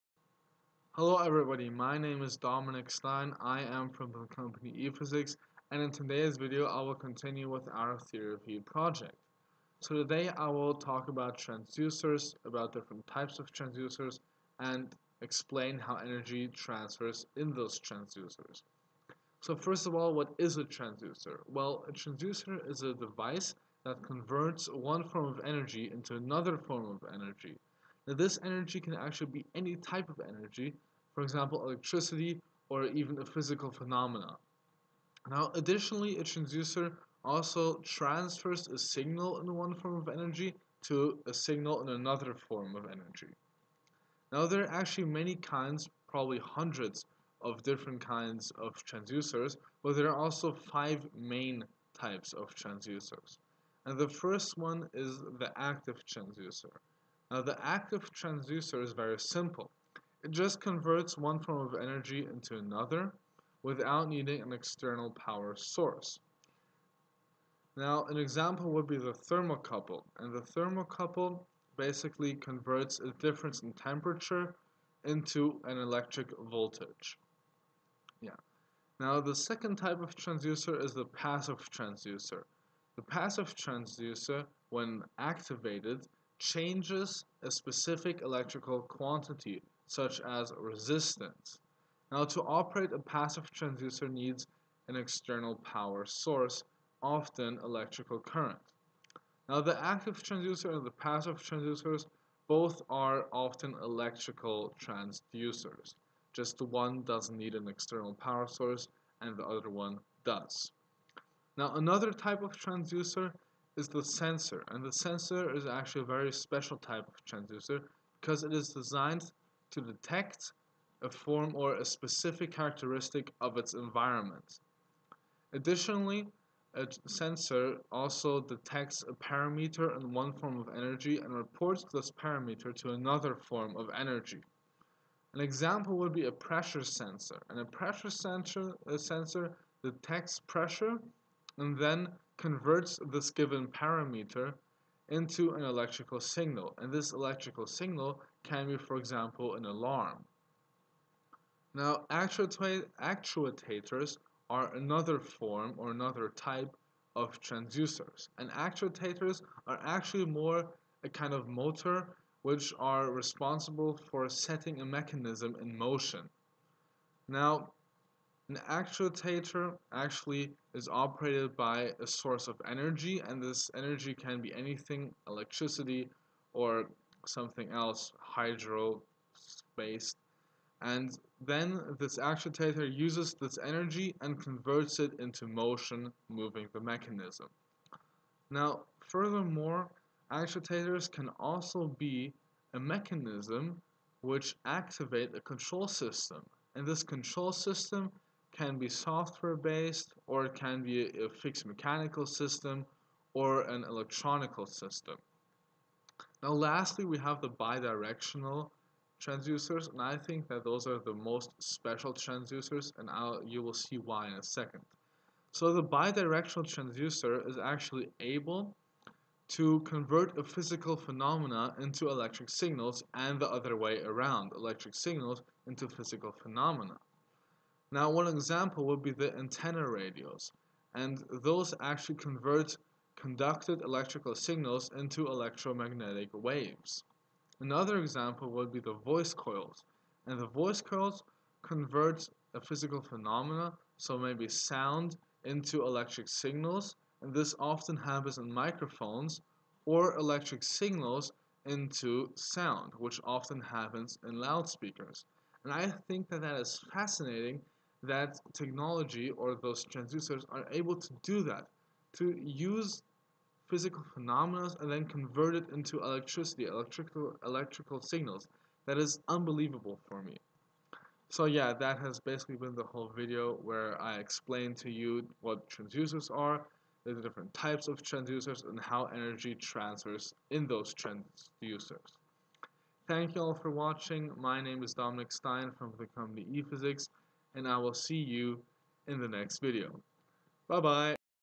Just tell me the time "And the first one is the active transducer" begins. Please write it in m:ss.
0:53.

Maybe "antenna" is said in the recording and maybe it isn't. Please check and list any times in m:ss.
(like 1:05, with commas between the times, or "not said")
3:49.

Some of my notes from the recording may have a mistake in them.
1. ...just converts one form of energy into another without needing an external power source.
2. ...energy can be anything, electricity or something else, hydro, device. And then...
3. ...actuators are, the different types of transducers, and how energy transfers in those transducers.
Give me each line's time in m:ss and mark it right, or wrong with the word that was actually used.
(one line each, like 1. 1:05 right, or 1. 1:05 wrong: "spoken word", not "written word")
1. 1:00 right
2. 2:53 wrong: "space", not "device"
3. 4:35 wrong: "transducers", not "actuators".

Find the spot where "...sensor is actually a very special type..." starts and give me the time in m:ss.
1:54.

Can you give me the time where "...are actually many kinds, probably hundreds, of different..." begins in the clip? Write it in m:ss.
0:44.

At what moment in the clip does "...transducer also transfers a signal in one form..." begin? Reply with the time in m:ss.
0:36.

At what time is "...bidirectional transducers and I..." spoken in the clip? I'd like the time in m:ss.
3:27.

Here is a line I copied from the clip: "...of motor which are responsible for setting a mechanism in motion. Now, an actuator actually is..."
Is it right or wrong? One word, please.
right.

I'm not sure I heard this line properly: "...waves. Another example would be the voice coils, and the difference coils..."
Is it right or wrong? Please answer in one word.
wrong.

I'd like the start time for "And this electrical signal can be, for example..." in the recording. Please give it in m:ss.
2:26.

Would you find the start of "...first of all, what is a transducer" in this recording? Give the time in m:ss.
0:19.